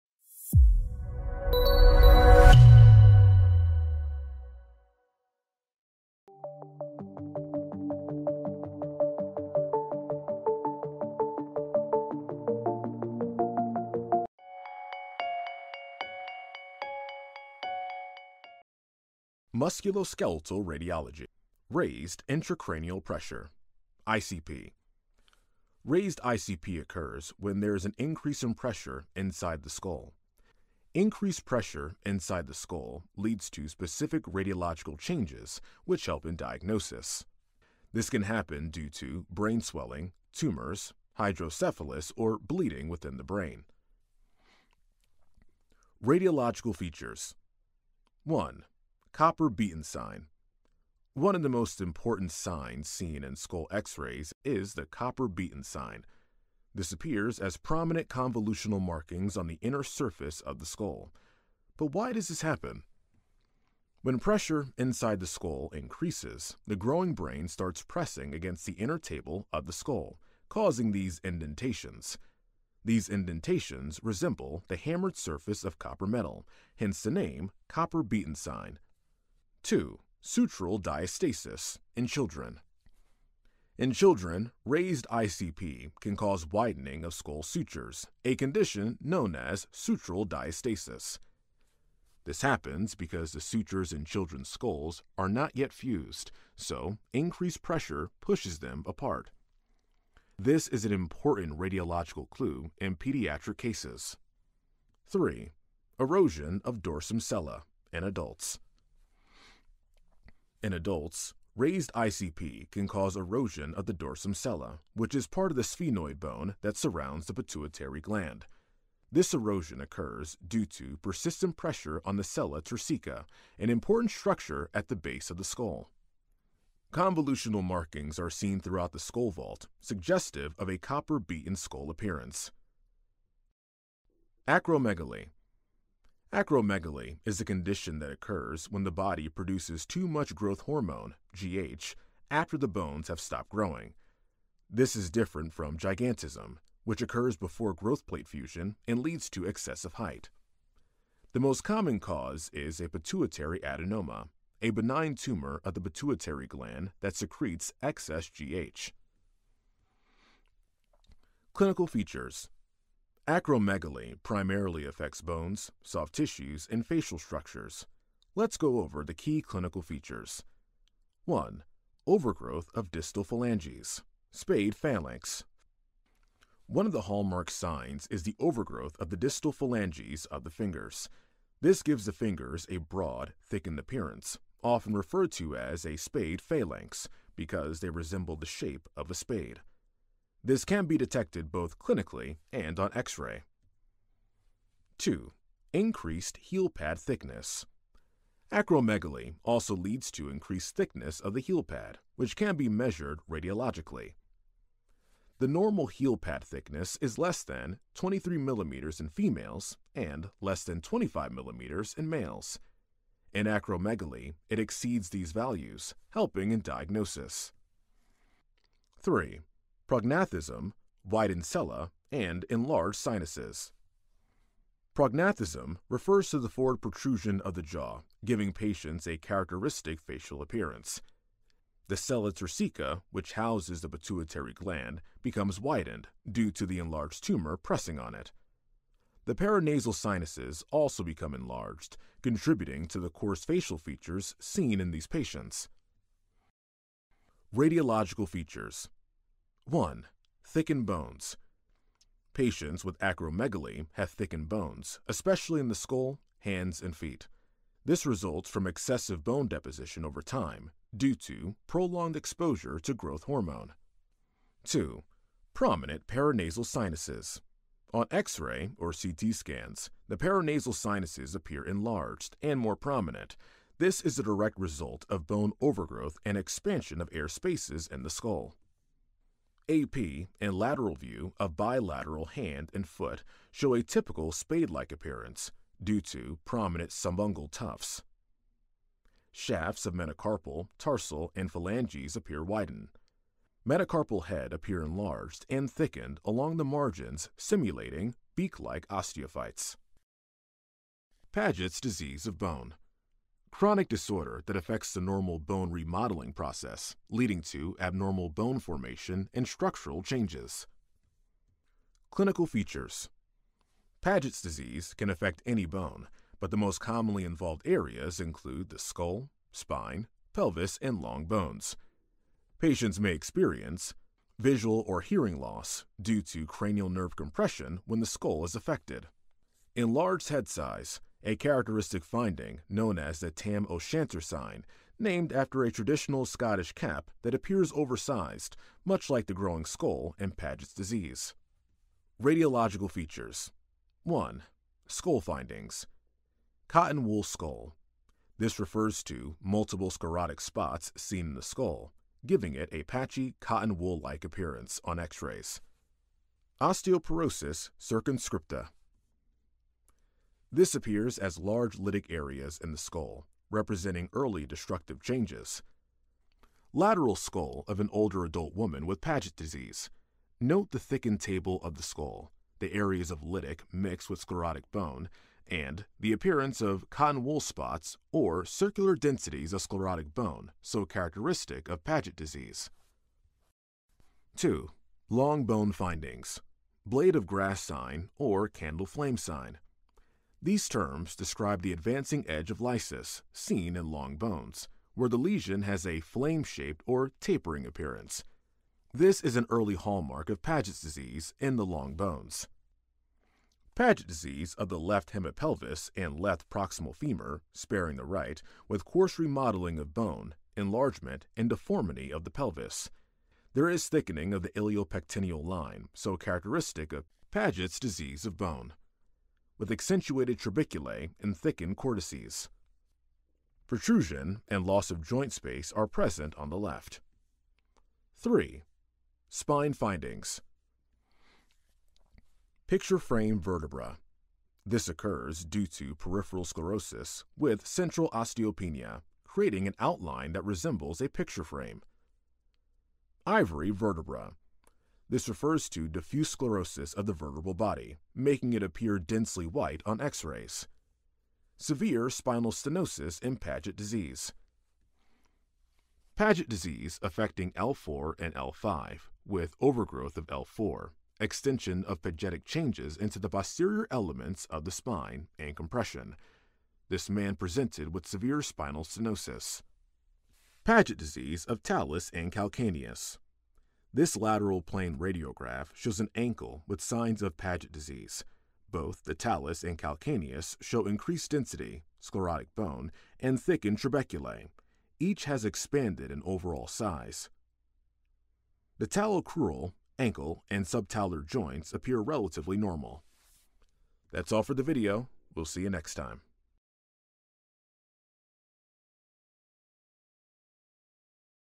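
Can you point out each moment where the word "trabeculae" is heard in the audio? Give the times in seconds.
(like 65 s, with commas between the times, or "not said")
420 s, 483 s.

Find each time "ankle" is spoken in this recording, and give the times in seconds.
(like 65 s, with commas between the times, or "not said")
476 s, 489 s.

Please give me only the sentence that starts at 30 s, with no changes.
Increased pressure inside the skull leads to specific radiological changes, which help in diagnosis.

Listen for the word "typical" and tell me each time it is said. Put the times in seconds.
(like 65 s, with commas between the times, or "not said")
283 s.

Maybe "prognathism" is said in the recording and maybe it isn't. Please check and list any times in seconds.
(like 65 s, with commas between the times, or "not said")
219 s, 224 s.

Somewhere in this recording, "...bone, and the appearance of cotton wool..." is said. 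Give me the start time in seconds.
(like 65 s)
374 s.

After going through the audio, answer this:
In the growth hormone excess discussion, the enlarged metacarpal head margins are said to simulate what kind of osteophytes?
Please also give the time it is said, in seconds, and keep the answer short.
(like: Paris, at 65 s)
Beak-like osteophytes, at 298 s.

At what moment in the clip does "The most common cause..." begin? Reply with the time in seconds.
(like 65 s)
151 s.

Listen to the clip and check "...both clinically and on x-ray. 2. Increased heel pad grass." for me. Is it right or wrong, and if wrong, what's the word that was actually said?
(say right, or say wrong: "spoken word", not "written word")
wrong: "thickness", not "grass".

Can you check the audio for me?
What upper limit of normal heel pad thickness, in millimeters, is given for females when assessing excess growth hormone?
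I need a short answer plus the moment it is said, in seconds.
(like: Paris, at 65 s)
23, at 207 s.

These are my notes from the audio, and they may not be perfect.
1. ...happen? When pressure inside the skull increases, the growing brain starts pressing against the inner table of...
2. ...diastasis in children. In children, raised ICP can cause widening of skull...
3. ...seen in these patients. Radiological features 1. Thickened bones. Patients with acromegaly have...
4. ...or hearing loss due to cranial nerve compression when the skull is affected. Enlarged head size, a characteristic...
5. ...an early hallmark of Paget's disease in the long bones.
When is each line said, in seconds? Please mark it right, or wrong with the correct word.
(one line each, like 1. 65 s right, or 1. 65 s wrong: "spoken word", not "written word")
1. 62 s right
2. 80 s right
3. 244 s right
4. 324 s right
5. 399 s right.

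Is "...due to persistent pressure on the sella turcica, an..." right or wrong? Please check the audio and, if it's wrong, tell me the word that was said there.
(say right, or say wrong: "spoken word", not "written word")
right.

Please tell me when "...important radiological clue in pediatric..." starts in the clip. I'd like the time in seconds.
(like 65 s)
100 s.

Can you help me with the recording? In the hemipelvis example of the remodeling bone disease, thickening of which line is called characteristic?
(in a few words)
Iliopectineal line.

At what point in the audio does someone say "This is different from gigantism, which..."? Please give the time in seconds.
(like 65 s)
144 s.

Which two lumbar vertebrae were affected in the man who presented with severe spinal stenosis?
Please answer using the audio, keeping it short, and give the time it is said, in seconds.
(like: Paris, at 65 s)
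L4 and L5, at 457 s.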